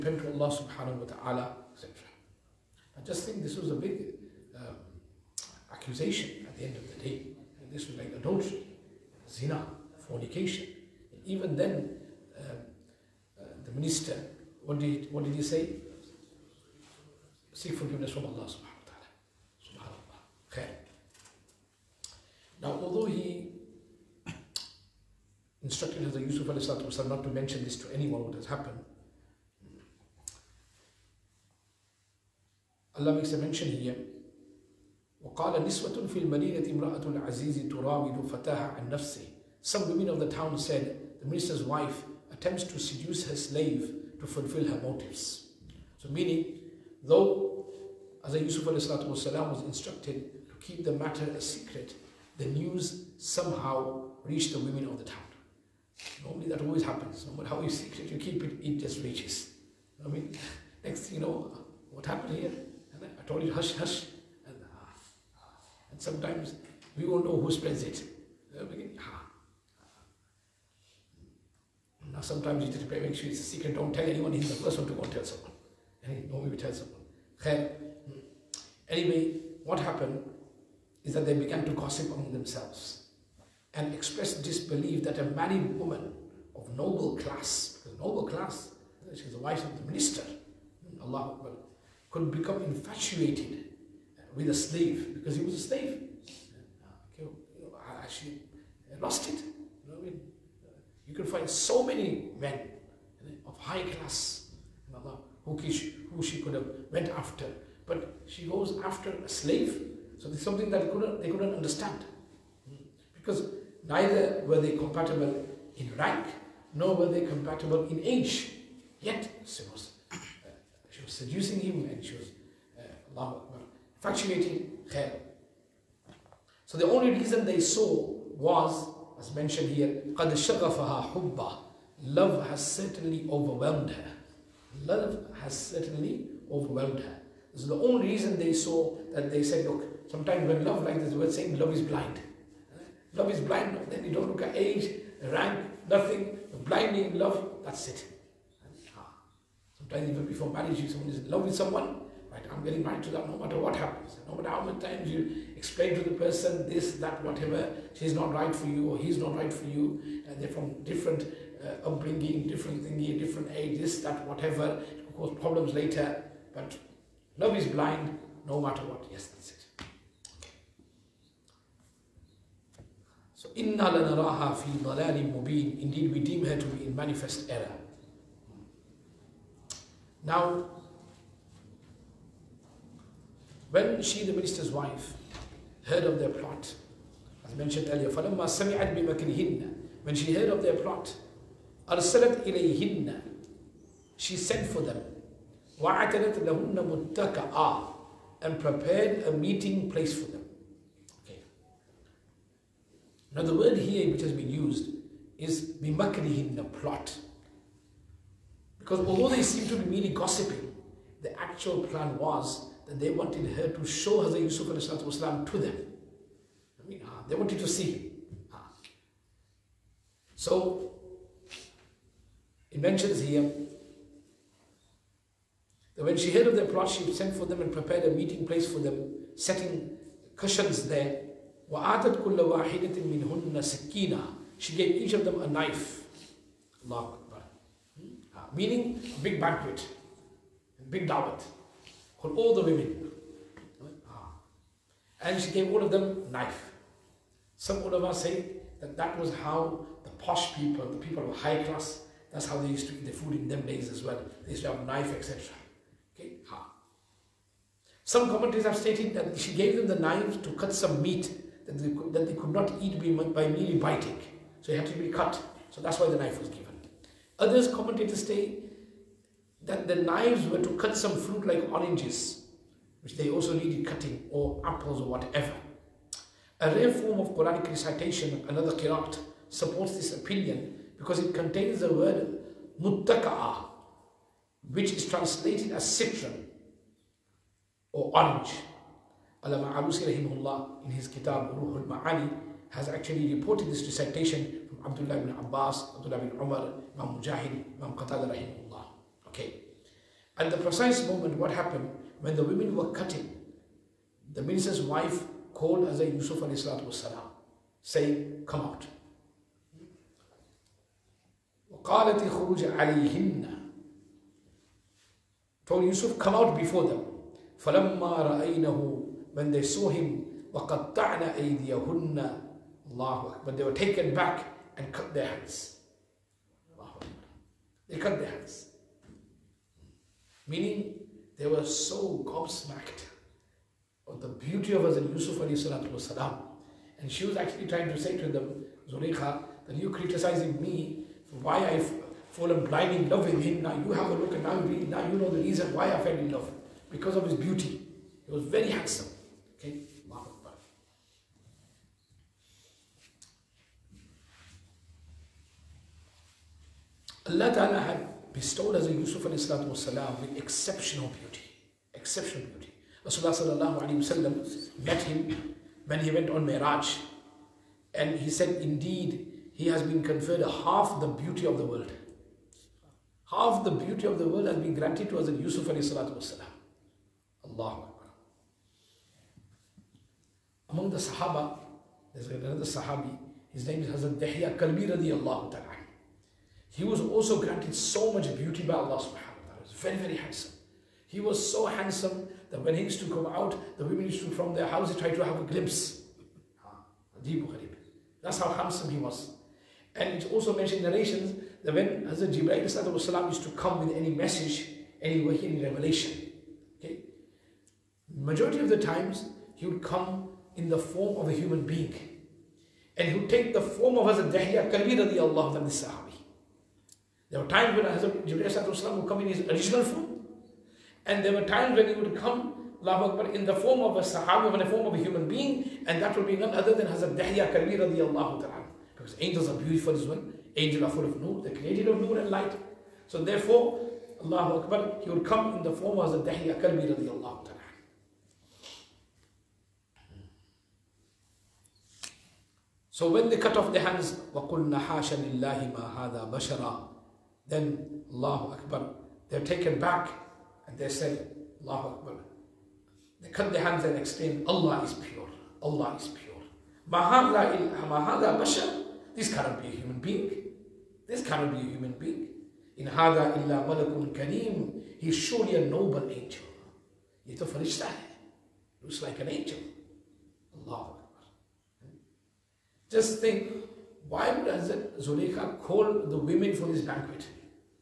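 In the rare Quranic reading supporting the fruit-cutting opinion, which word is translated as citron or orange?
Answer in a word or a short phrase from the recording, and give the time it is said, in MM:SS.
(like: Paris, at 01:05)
muttaka'a, at 04:42.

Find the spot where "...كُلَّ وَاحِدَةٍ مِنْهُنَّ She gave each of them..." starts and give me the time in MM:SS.
03:52.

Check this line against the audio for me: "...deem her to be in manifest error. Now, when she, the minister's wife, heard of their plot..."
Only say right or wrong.
right.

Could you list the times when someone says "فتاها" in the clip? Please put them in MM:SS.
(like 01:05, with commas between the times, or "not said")
00:38.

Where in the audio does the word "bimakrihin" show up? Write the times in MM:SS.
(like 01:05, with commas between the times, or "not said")
03:25.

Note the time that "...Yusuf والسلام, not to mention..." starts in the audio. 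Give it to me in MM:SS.
00:26.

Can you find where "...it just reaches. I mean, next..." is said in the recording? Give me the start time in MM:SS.
00:58.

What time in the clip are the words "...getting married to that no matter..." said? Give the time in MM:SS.
02:32.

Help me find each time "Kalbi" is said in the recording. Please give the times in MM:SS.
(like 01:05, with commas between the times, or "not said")
06:24, 06:54, 07:07, 07:16.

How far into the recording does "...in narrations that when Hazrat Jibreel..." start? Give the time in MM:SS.
06:40.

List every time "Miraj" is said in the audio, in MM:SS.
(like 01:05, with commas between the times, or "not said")
06:06.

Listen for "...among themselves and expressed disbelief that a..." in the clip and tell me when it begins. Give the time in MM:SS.
01:22.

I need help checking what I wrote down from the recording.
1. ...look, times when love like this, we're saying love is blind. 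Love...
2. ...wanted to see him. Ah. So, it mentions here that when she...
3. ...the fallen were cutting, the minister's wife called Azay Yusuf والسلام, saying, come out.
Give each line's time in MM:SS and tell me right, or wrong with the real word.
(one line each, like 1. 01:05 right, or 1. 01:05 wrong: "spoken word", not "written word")
1. 02:19 wrong: "sometimes", not "times"
2. 03:37 right
3. 05:02 wrong: "women", not "fallen".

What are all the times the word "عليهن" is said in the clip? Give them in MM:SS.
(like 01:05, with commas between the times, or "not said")
05:12.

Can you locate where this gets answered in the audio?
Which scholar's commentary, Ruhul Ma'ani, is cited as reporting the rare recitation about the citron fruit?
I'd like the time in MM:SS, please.
04:49.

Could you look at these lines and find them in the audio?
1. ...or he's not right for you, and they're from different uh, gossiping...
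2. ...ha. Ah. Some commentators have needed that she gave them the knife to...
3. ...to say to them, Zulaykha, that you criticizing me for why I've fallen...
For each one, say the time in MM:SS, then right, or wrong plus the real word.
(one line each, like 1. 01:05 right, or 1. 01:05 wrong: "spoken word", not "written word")
1. 02:38 wrong: "upbringing", not "gossiping"
2. 04:16 wrong: "stated", not "needed"
3. 05:37 right.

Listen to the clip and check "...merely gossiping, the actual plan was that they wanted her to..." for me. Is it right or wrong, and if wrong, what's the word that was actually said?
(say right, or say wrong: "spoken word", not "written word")
right.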